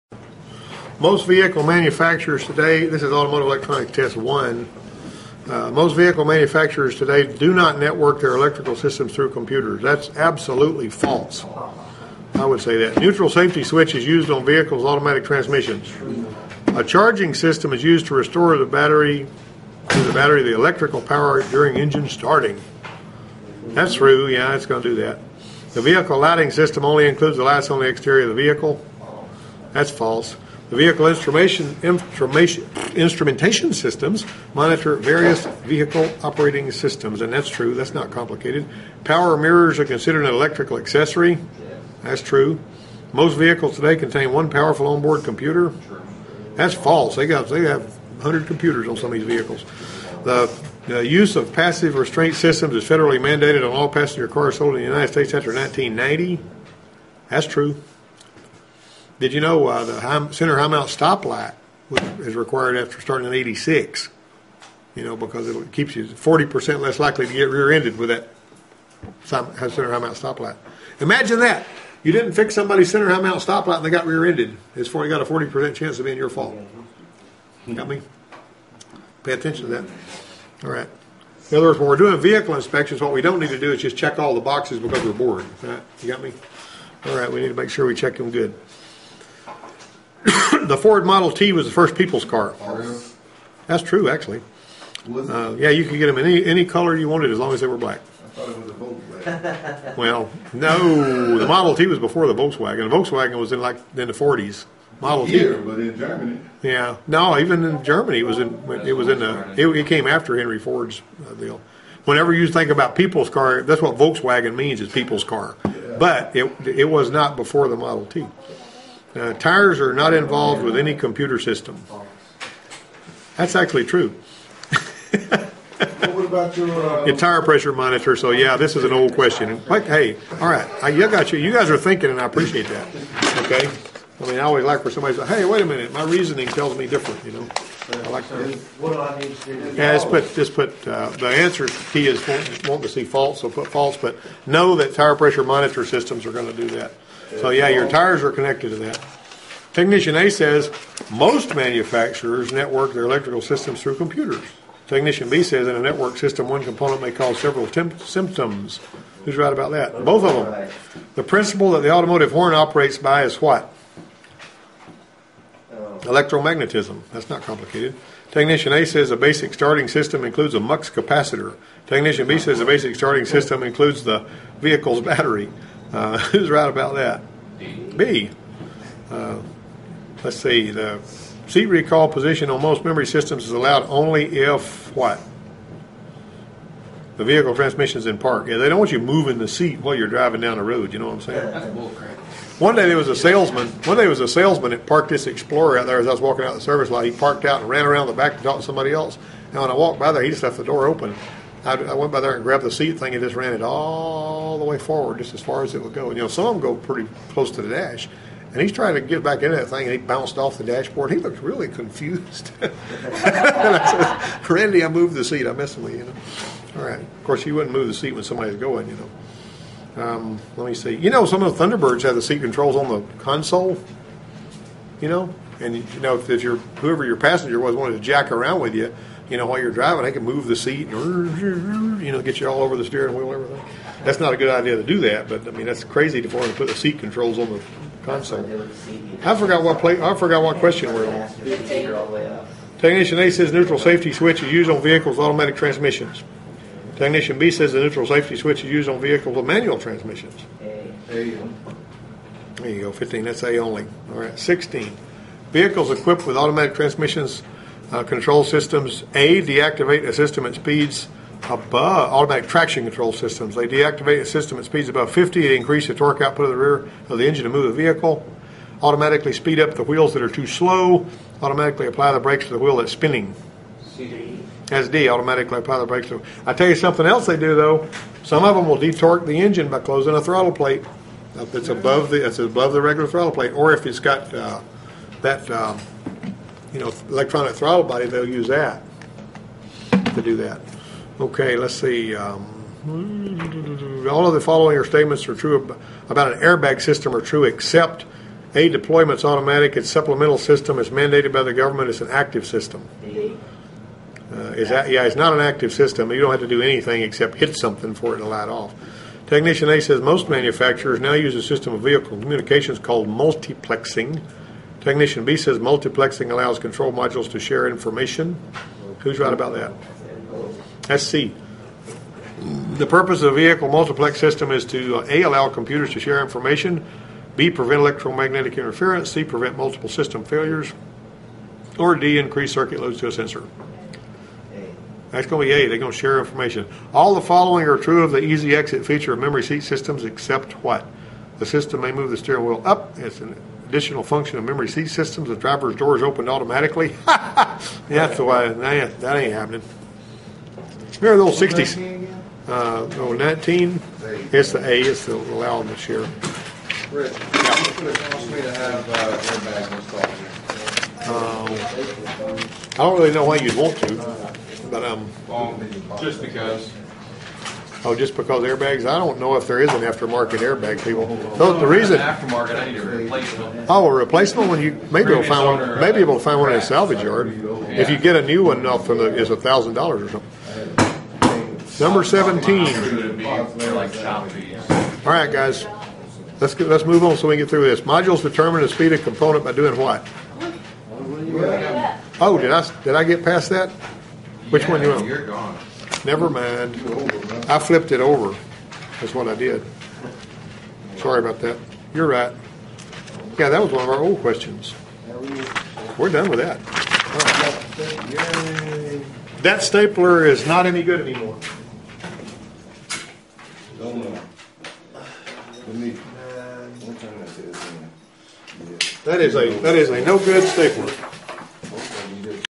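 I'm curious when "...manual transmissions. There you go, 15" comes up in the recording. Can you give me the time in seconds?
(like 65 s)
249 s.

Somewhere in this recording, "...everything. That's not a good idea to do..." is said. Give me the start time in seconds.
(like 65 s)
233 s.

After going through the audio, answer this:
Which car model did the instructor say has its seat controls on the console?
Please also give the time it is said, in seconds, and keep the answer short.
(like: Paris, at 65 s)
Thunderbirds, at 221 s.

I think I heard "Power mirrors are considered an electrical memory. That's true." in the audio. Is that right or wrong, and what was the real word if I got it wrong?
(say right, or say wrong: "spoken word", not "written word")
wrong: "accessory", not "memory".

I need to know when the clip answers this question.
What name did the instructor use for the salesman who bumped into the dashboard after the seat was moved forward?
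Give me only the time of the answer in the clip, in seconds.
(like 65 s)
214 s.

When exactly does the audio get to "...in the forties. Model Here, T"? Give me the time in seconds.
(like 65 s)
103 s.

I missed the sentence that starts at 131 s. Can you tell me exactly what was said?
You guys are thinking, and I appreciate that.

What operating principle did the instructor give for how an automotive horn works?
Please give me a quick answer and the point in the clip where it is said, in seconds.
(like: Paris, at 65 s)
Electromagnetism, at 165 s.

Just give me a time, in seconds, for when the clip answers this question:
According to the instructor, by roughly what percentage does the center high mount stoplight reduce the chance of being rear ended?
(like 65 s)
66 s.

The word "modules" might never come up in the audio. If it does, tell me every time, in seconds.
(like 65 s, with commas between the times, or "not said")
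316 s, 387 s.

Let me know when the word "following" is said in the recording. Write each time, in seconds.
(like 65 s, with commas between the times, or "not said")
294 s, 337 s.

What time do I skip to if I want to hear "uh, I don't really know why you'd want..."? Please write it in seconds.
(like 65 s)
361 s.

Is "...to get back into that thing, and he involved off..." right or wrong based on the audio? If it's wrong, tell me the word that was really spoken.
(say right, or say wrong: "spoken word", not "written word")
wrong: "bounced", not "involved".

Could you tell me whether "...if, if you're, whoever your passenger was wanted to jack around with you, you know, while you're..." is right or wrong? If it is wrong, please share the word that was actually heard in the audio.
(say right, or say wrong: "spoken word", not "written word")
right.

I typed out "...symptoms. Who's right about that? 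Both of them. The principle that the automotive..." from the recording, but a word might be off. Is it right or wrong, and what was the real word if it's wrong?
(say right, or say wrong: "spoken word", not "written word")
right.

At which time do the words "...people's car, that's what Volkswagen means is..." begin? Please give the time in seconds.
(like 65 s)
112 s.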